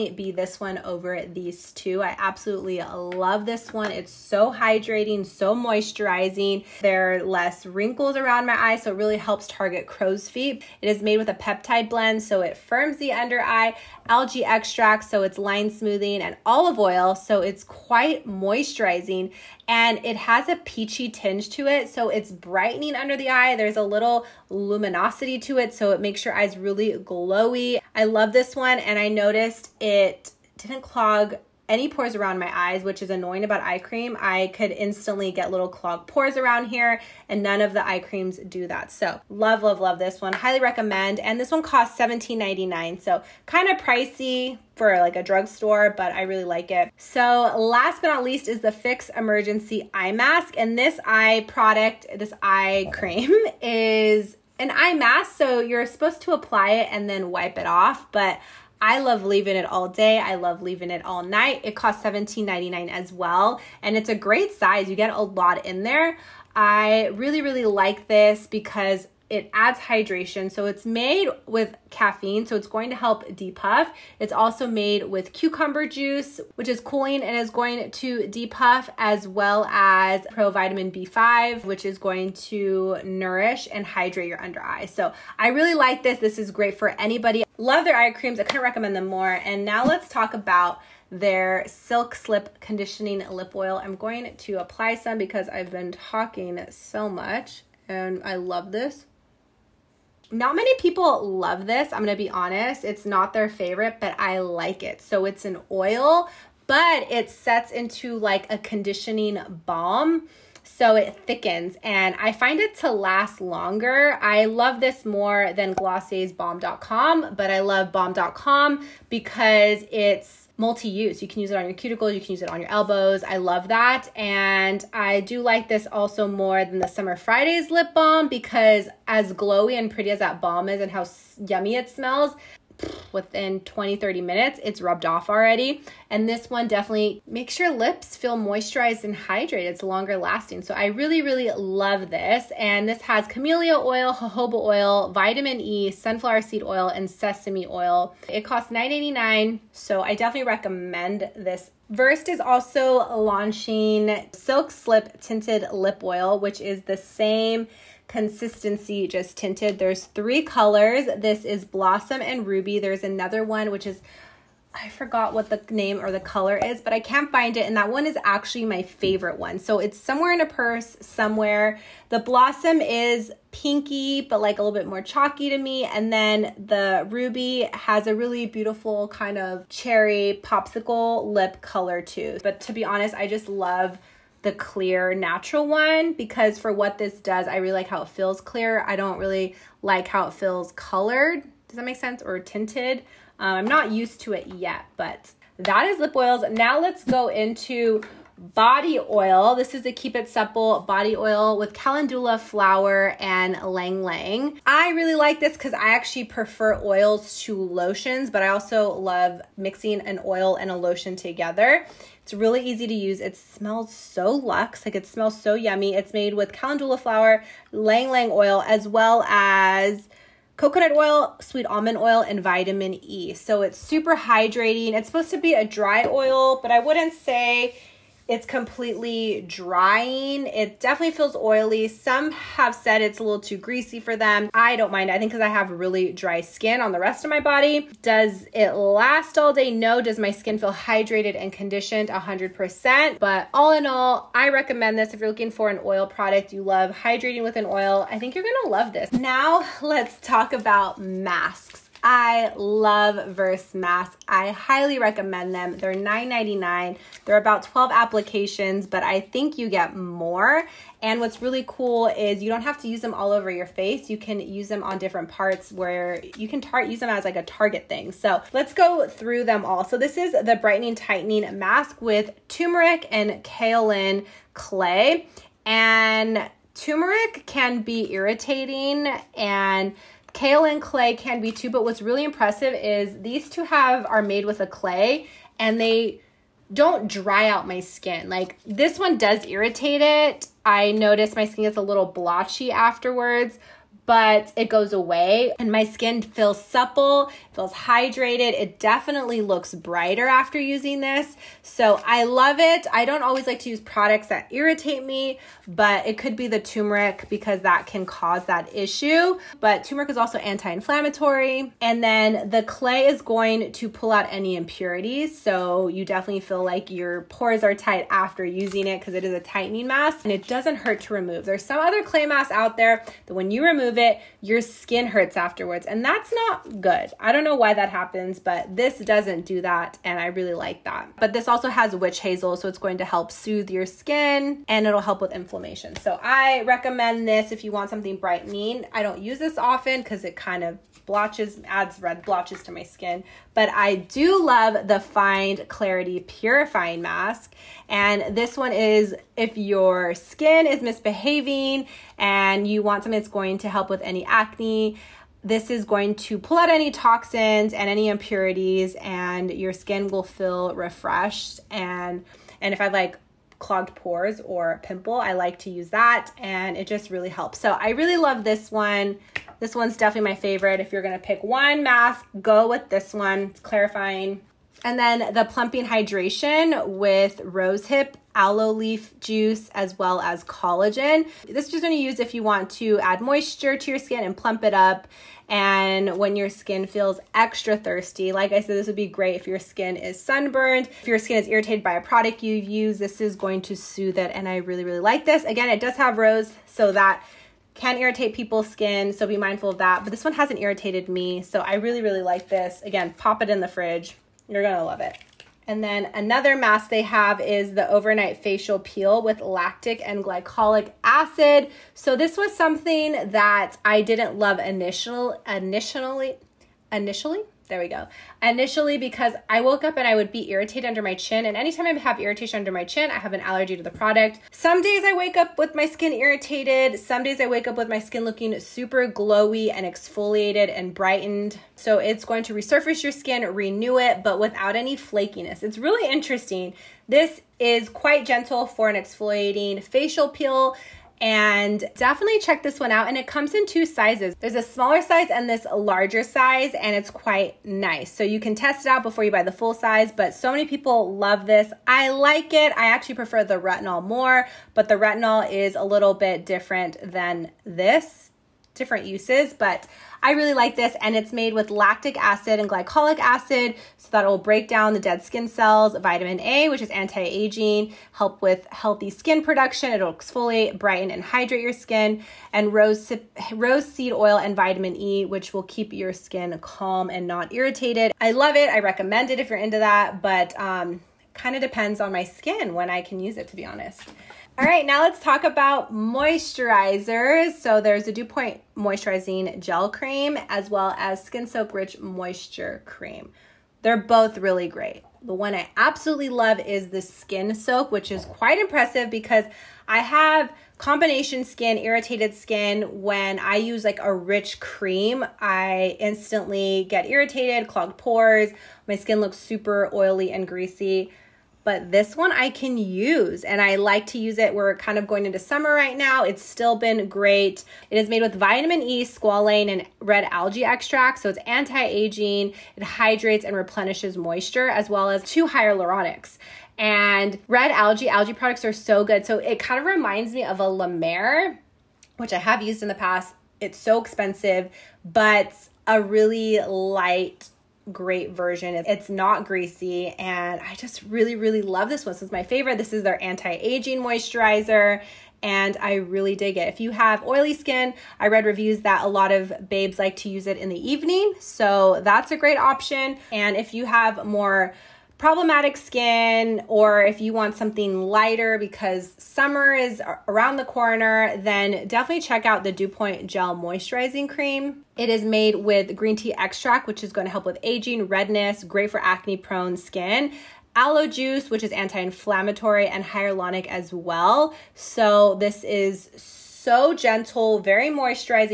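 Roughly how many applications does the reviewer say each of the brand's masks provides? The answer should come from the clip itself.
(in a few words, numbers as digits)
12.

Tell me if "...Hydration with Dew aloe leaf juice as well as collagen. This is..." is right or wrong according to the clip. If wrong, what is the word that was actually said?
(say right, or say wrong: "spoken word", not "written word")
wrong: "Rosehip", not "Dew".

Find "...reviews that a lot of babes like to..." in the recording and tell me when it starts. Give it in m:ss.
9:08.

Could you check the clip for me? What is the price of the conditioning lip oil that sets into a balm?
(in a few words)
$9.89.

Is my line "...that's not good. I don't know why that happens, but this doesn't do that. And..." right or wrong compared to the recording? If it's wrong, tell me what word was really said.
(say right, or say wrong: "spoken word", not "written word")
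right.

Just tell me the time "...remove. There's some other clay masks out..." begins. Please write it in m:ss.
5:21.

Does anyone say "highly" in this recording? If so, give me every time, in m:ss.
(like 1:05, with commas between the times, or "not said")
0:40, 4:14.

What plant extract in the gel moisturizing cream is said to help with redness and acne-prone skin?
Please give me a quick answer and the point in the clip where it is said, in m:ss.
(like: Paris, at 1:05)
green tea extract, at 9:25.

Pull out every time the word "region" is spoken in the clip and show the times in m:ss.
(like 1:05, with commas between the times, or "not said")
not said.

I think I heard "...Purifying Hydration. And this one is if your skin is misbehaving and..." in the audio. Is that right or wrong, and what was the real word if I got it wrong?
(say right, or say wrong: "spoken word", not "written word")
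wrong: "Mask", not "Hydration".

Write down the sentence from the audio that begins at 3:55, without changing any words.
I think because I have really dry skin on the rest of my body.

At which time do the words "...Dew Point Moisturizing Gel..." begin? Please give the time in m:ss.
8:08.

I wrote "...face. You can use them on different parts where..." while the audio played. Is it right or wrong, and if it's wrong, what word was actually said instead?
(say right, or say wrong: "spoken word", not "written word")
right.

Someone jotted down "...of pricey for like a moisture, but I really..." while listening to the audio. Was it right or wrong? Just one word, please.
wrong.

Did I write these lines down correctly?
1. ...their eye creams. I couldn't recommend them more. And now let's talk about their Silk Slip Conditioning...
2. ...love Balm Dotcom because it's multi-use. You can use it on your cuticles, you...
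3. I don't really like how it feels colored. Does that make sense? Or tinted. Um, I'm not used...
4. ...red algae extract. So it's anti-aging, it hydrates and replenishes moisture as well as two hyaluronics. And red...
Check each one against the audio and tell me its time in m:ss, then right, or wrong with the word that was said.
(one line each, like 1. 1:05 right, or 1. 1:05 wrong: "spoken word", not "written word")
1. 1:27 right
2. 1:57 right
3. 3:08 right
4. 8:39 right.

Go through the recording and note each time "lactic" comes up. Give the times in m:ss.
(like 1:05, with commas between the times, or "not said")
6:49, 7:41.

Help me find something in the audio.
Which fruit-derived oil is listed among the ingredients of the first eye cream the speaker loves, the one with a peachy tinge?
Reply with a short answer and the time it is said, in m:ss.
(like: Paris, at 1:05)
olive oil, at 0:16.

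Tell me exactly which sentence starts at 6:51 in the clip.
So this was something that I didn't love initial, initially, initially, there we go.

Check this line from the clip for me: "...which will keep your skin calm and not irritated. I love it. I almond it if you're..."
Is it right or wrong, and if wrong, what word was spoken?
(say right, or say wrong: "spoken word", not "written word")
wrong: "recommend", not "almond".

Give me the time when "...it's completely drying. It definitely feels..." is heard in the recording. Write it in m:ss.
3:48.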